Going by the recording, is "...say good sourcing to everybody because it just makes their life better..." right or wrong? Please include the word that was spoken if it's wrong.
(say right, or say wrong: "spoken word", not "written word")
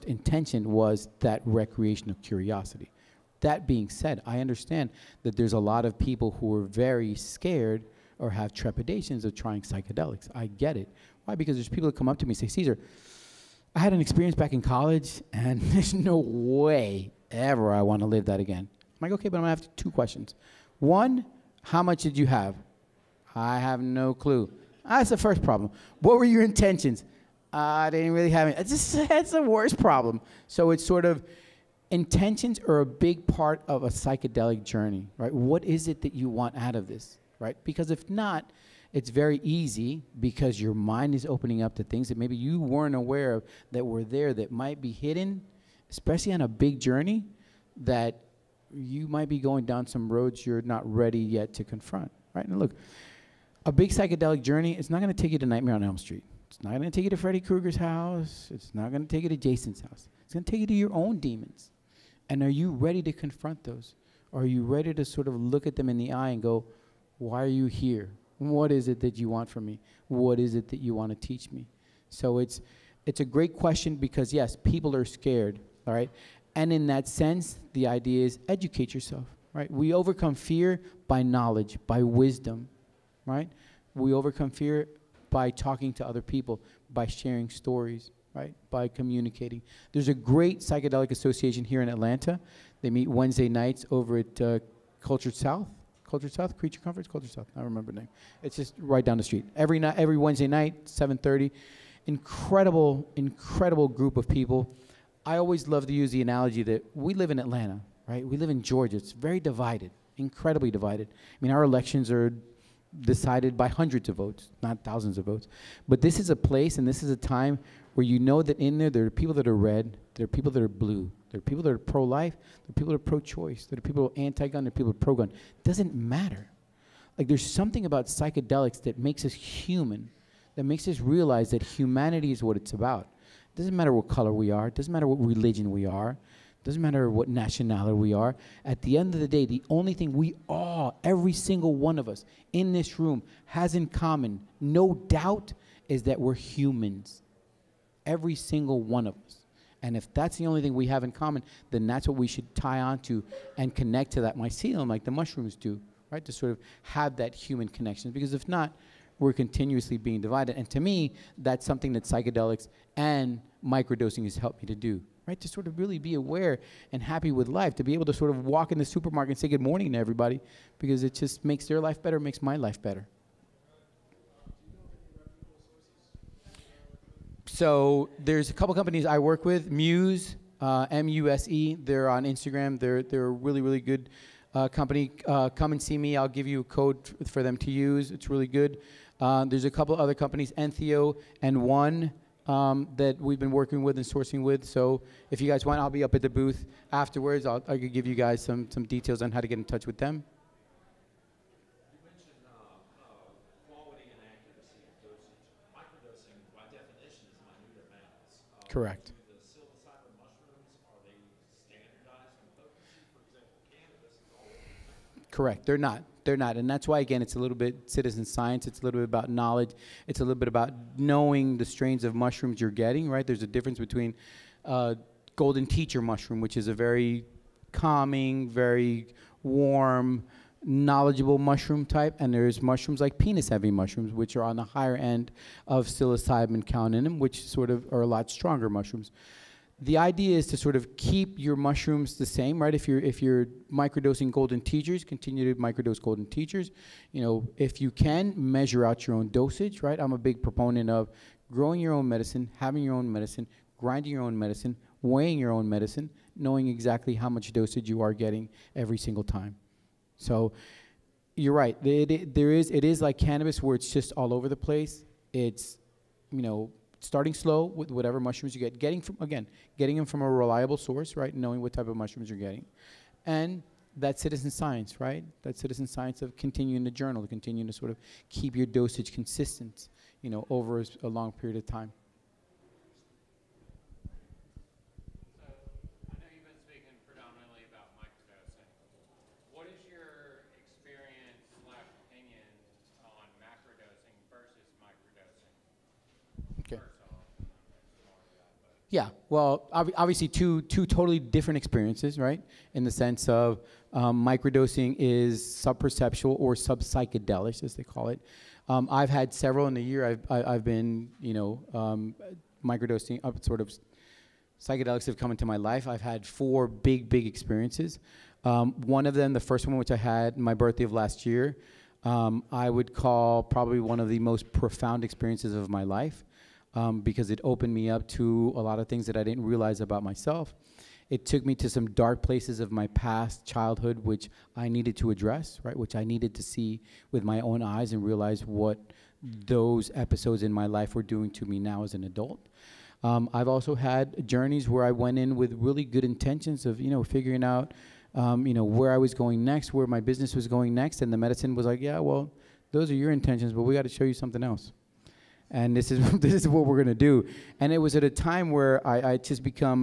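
wrong: "morning", not "sourcing".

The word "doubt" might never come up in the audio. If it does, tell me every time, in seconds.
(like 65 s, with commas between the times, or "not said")
145 s.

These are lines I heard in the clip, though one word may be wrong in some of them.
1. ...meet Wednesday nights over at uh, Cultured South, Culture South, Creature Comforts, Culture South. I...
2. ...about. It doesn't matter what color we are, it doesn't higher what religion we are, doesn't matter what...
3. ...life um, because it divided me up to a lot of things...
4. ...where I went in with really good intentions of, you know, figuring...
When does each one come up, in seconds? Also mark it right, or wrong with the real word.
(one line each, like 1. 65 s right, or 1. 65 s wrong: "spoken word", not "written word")
1. 92 s right
2. 132 s wrong: "matter", not "higher"
3. 325 s wrong: "opened", not "divided"
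4. 344 s right.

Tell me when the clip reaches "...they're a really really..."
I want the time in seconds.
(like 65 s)
183 s.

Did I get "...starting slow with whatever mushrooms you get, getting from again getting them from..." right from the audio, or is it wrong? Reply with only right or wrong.
right.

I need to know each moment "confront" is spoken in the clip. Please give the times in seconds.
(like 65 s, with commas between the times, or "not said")
51 s, 63 s.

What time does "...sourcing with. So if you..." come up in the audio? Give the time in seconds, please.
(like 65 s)
194 s.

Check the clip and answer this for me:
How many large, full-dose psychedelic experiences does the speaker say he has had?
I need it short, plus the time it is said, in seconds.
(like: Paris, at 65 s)
4, at 316 s.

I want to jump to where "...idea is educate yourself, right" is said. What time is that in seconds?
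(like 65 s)
77 s.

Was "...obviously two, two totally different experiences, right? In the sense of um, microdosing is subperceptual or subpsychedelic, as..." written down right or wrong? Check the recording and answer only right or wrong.
right.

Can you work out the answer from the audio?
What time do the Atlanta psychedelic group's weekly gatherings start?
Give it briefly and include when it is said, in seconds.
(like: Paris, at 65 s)
7:30, at 100 s.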